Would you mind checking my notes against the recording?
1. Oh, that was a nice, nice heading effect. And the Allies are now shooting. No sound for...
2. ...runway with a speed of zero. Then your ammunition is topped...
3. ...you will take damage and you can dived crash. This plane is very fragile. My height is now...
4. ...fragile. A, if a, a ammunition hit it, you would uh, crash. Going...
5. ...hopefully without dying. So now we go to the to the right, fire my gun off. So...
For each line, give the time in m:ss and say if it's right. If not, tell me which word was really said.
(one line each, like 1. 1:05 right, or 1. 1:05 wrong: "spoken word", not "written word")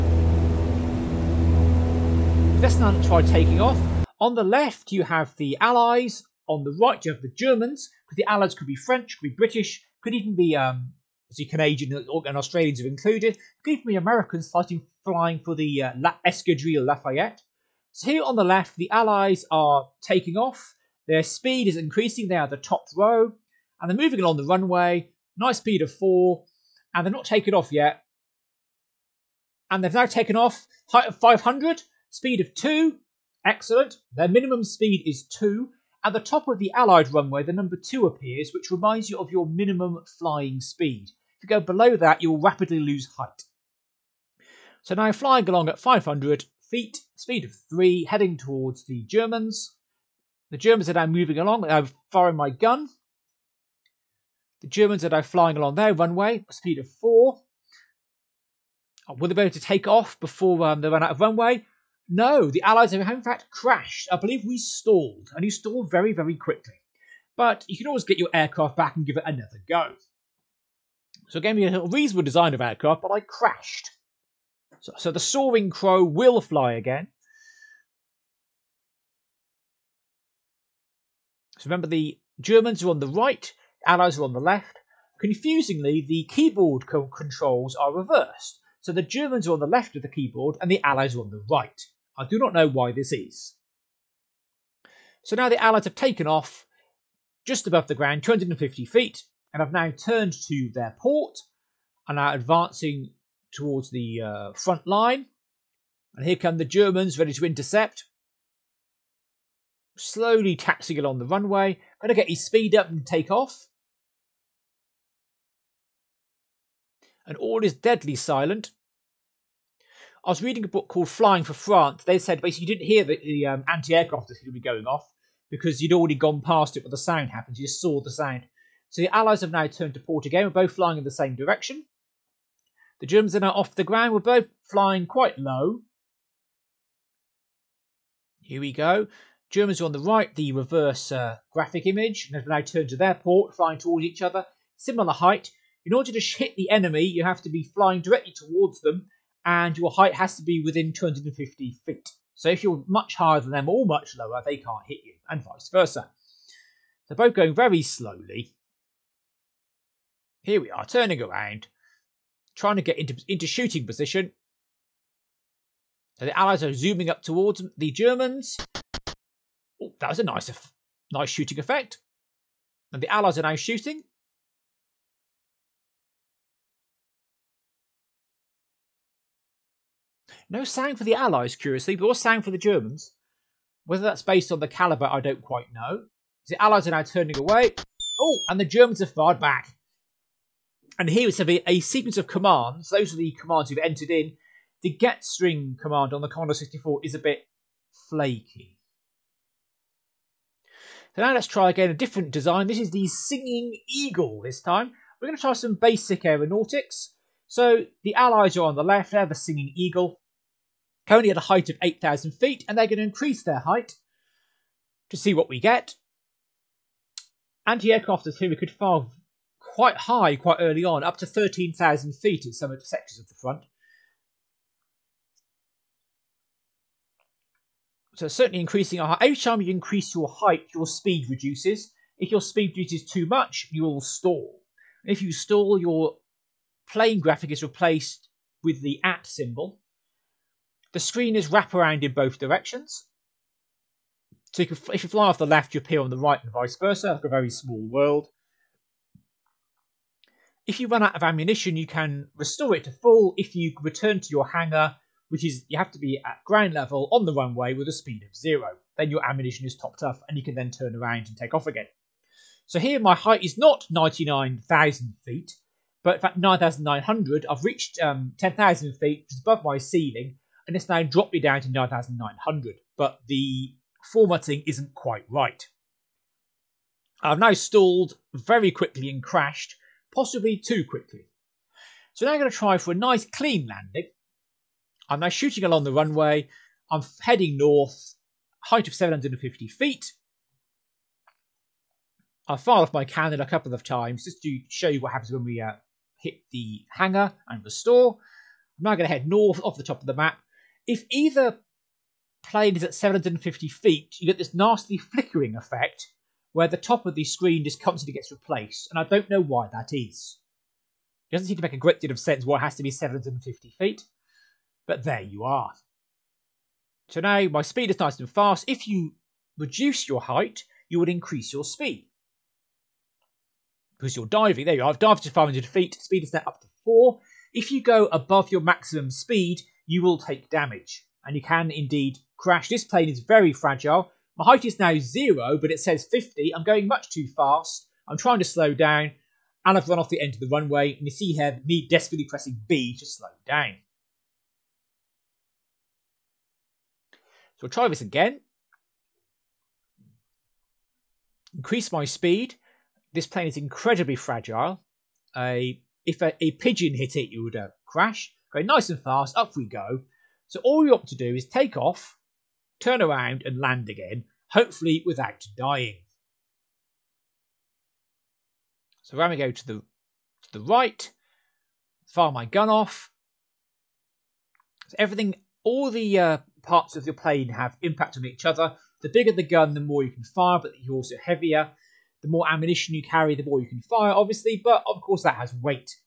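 1. 2:49 wrong: "shooting", not "heading"
2. 4:17 right
3. 5:29 wrong: "indeed", not "dived"
4. 5:54 wrong: "pigeon", not "ammunition"
5. 6:04 right.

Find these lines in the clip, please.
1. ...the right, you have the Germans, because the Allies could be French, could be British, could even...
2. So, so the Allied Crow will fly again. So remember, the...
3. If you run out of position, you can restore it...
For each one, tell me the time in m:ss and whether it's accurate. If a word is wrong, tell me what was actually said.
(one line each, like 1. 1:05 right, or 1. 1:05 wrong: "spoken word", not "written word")
1. 0:06 right
2. 1:14 wrong: "Soaring", not "Allied"
3. 4:10 wrong: "ammunition", not "position".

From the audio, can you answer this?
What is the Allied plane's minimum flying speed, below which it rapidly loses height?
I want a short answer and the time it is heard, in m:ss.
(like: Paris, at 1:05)
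2, at 0:37.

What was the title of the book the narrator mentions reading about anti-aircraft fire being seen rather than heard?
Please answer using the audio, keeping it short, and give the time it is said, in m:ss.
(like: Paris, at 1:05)
Flying for France, at 2:01.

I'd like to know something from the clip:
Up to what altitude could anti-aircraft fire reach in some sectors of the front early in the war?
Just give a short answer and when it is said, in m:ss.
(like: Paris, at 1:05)
13,000 feet, at 3:41.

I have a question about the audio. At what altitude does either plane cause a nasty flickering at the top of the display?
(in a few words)
750 feet.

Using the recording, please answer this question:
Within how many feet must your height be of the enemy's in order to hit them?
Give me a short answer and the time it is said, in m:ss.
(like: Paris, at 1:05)
250 feet, at 2:30.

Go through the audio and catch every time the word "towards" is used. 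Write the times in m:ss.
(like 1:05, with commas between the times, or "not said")
0:48, 1:43, 2:23, 2:28, 2:47.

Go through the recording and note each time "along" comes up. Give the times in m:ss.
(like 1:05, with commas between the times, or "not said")
0:24, 0:45, 0:51, 0:55, 1:50, 4:45.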